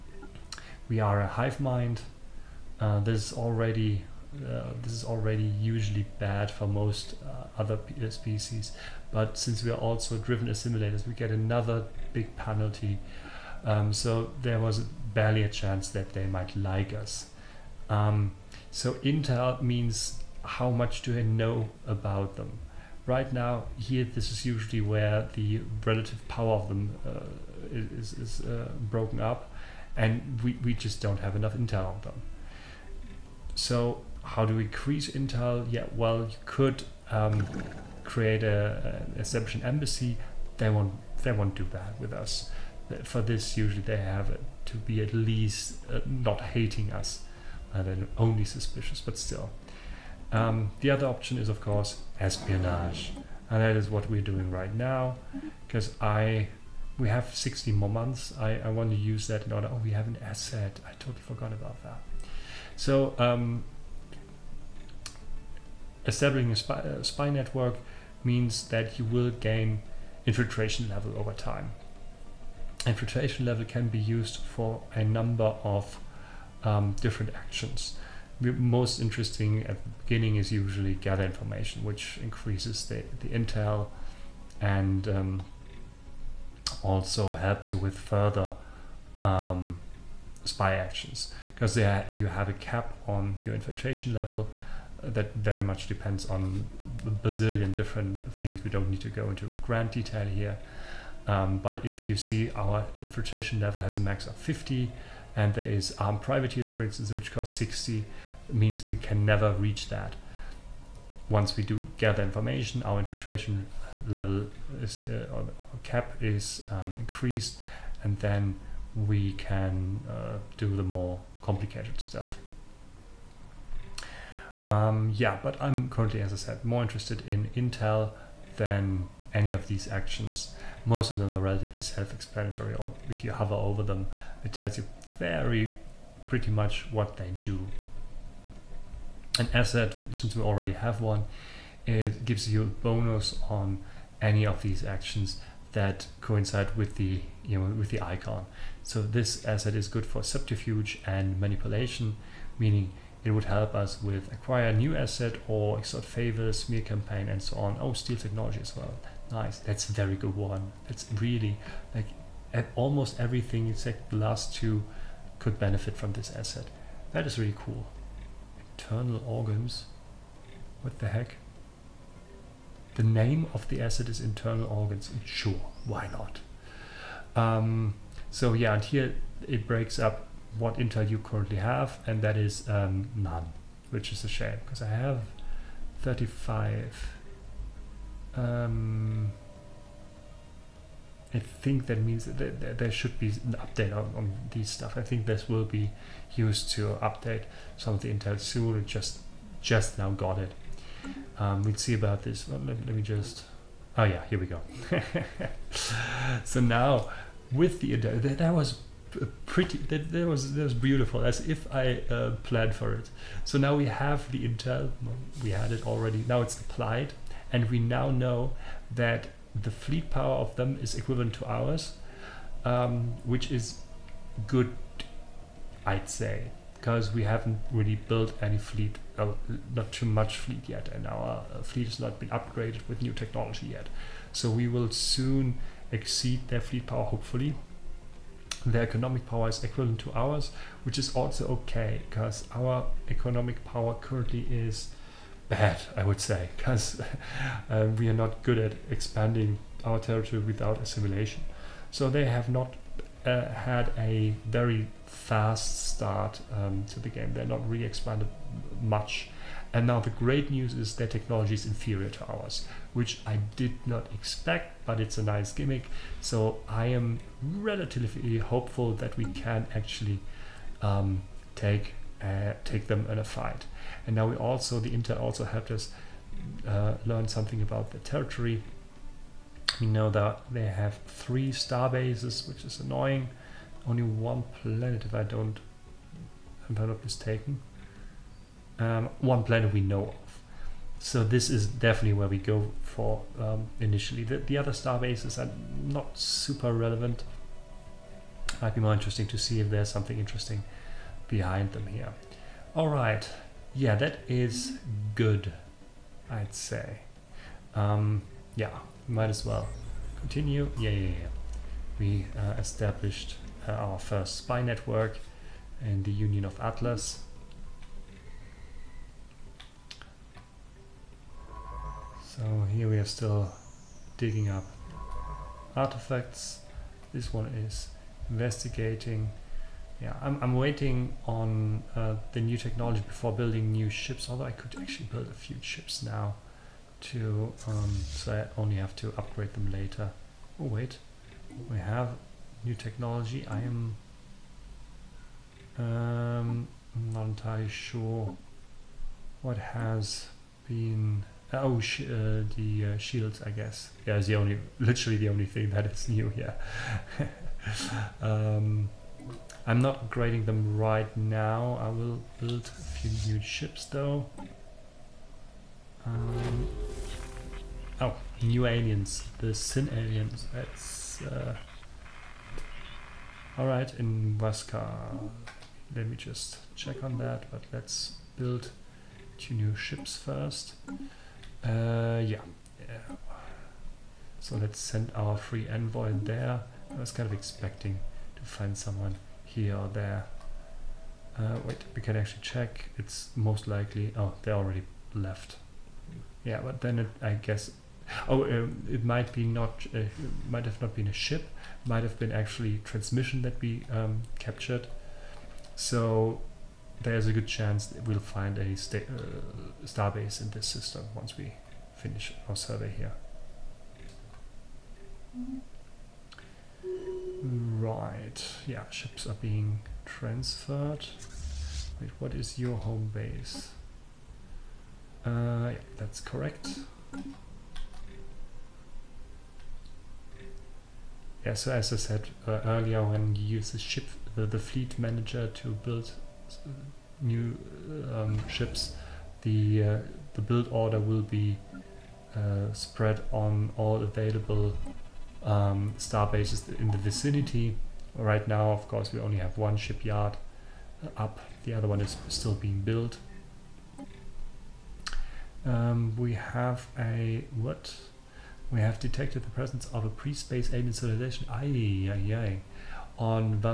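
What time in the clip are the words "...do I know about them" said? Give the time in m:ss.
0:21.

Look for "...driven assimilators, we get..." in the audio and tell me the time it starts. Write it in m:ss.
0:10.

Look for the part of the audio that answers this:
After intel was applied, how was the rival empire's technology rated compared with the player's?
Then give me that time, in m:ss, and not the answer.
4:21.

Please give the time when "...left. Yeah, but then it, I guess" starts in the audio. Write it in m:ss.
6:35.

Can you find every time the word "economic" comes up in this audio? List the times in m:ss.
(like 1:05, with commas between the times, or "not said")
3:58, 4:03.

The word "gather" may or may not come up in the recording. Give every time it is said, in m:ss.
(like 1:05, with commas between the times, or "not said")
1:20, 1:51.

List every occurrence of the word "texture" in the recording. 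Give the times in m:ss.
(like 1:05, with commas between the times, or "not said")
not said.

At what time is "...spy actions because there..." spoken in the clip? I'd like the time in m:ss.
1:30.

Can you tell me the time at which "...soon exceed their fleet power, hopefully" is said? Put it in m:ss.
3:54.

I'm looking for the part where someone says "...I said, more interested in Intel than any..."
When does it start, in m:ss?
2:06.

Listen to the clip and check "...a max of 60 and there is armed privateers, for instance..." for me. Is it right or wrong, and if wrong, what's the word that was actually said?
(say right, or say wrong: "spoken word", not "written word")
wrong: "50", not "60".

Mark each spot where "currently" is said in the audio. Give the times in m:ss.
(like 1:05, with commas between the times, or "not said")
2:05, 3:01, 4:03.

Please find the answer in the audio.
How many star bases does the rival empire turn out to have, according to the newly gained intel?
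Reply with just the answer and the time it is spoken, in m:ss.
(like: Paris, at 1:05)
3, at 4:41.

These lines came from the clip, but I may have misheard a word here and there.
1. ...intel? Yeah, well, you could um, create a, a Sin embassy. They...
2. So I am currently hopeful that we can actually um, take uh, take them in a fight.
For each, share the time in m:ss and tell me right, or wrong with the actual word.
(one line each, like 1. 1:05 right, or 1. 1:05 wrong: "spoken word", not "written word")
1. 0:35 wrong: "Egyptian", not "Sin"
2. 4:26 wrong: "relatively", not "currently".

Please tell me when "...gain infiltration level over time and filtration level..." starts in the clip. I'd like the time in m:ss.
1:09.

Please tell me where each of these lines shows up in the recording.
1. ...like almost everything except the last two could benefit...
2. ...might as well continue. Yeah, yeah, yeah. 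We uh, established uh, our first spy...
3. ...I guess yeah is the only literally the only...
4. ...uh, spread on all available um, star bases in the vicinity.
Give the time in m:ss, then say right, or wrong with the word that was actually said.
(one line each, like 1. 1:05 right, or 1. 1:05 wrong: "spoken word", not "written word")
1. 2:41 right
2. 5:09 right
3. 5:53 right
4. 7:22 right.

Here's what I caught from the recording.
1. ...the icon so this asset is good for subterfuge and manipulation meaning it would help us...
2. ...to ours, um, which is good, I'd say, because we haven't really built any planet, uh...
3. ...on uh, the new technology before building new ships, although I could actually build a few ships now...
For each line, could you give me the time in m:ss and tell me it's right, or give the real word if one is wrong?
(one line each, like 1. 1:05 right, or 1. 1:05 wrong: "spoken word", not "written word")
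1. 2:27 right
2. 3:41 wrong: "fleet", not "planet"
3. 5:31 right.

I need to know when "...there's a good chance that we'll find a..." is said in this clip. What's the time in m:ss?
6:47.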